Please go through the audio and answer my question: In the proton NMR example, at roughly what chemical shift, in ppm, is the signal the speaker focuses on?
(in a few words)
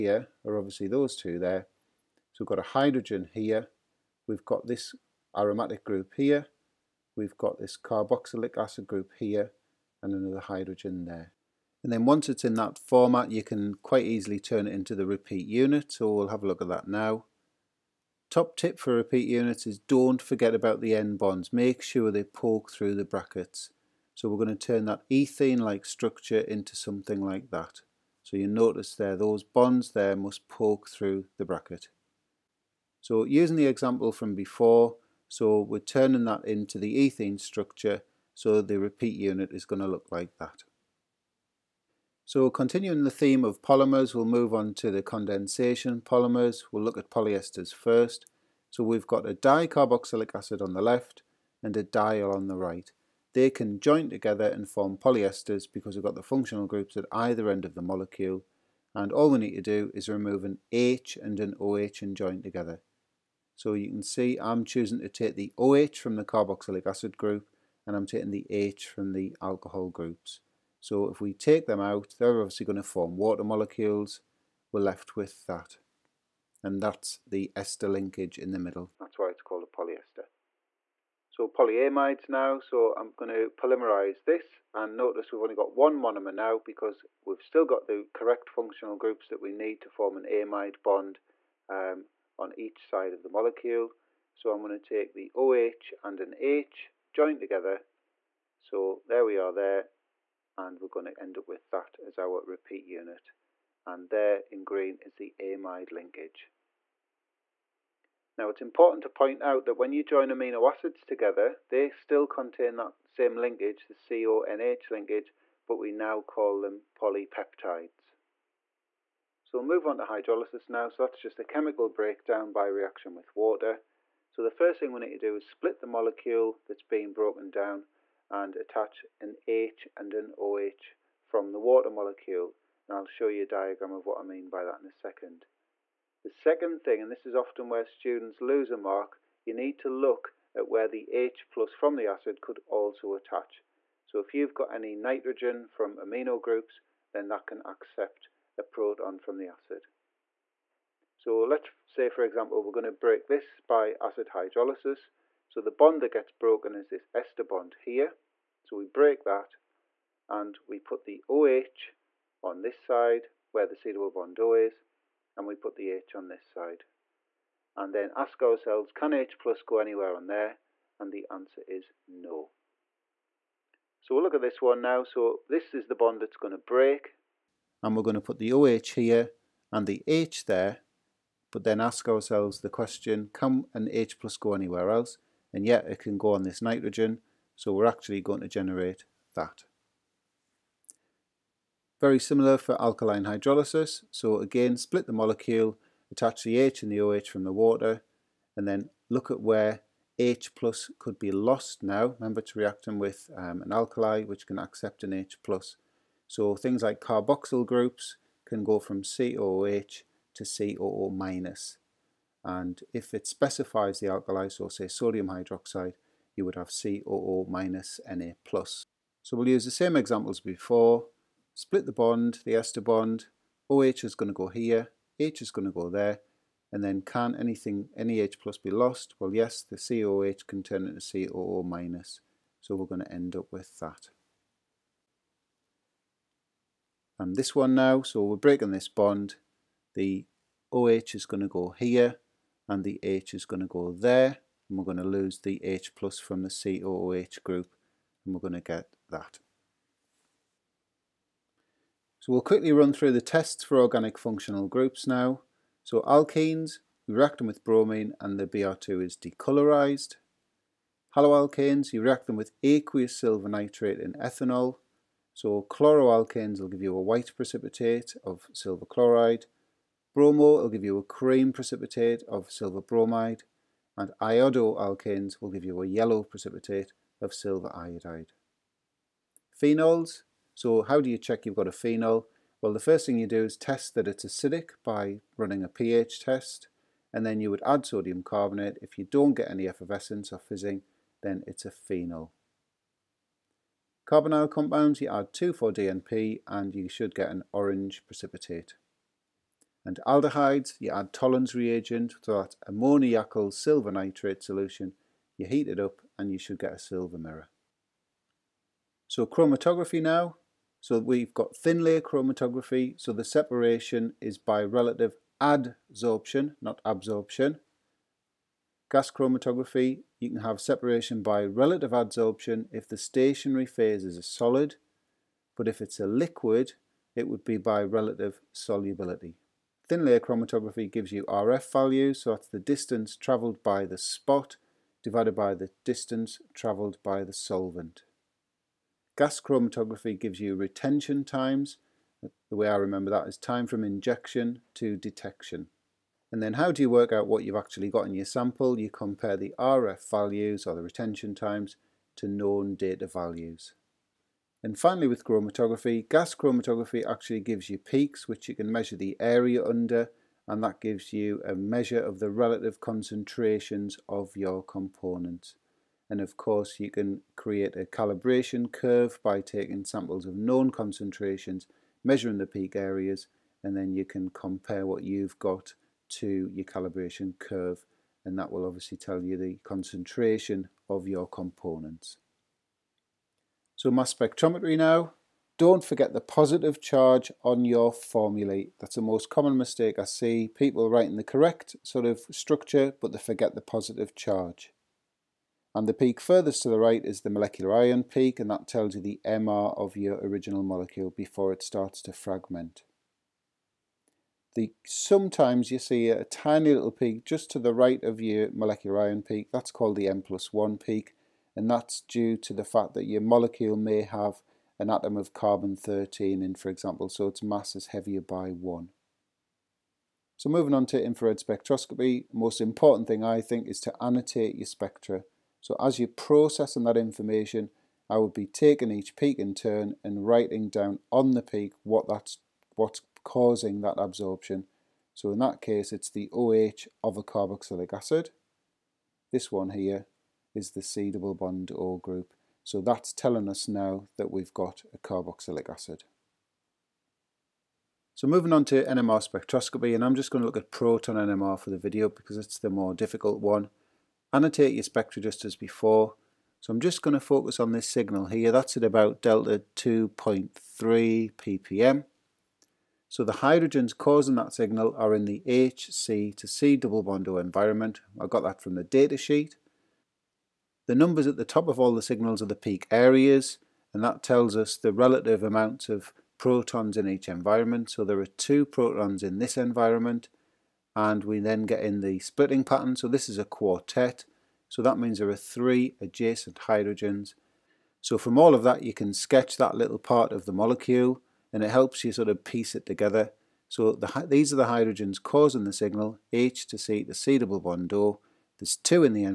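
2.3.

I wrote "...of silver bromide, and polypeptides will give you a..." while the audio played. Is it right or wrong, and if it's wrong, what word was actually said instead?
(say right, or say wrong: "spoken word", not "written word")
wrong: "iodoalkanes", not "polypeptides".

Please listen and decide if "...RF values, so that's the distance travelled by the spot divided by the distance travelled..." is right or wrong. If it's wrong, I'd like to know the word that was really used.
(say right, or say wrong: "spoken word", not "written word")
right.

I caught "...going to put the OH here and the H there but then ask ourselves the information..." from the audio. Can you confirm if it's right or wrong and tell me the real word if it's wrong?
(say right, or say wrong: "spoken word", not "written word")
wrong: "question", not "information".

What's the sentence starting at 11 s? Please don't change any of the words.
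And then once it's in that format, you can quite easily turn it into the repeat unit.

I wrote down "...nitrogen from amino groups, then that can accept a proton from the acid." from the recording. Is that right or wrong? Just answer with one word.
right.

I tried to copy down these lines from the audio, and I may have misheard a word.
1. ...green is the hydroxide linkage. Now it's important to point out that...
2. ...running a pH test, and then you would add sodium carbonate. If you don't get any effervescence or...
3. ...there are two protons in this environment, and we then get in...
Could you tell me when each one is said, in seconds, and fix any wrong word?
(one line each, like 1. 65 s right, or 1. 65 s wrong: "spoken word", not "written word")
1. 104 s wrong: "amide", not "hydroxide"
2. 285 s right
3. 478 s right.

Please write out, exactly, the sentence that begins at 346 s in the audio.
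And then how do you work out what you've actually got in your sample?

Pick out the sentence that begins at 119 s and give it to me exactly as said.
So we'll move on to hydrolysis now, so that's just a chemical breakdown by reaction with water.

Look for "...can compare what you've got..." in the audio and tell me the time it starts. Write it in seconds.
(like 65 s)
374 s.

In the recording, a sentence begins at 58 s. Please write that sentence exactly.
And all we need to do is remove an H and an OH and join together.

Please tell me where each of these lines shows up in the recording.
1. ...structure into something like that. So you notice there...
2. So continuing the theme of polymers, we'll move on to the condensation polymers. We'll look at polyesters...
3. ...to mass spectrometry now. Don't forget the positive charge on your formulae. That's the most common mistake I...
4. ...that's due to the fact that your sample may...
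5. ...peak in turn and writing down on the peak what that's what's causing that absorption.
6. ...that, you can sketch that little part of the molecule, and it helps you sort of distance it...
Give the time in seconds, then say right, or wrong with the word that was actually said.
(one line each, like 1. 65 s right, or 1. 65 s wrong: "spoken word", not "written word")
1. 25 s right
2. 42 s right
3. 383 s right
4. 411 s wrong: "molecule", not "sample"
5. 429 s right
6. 488 s wrong: "piece", not "distance".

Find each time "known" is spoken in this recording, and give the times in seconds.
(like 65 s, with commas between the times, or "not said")
352 s, 370 s.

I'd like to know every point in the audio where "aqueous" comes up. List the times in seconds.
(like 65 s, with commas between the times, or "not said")
262 s.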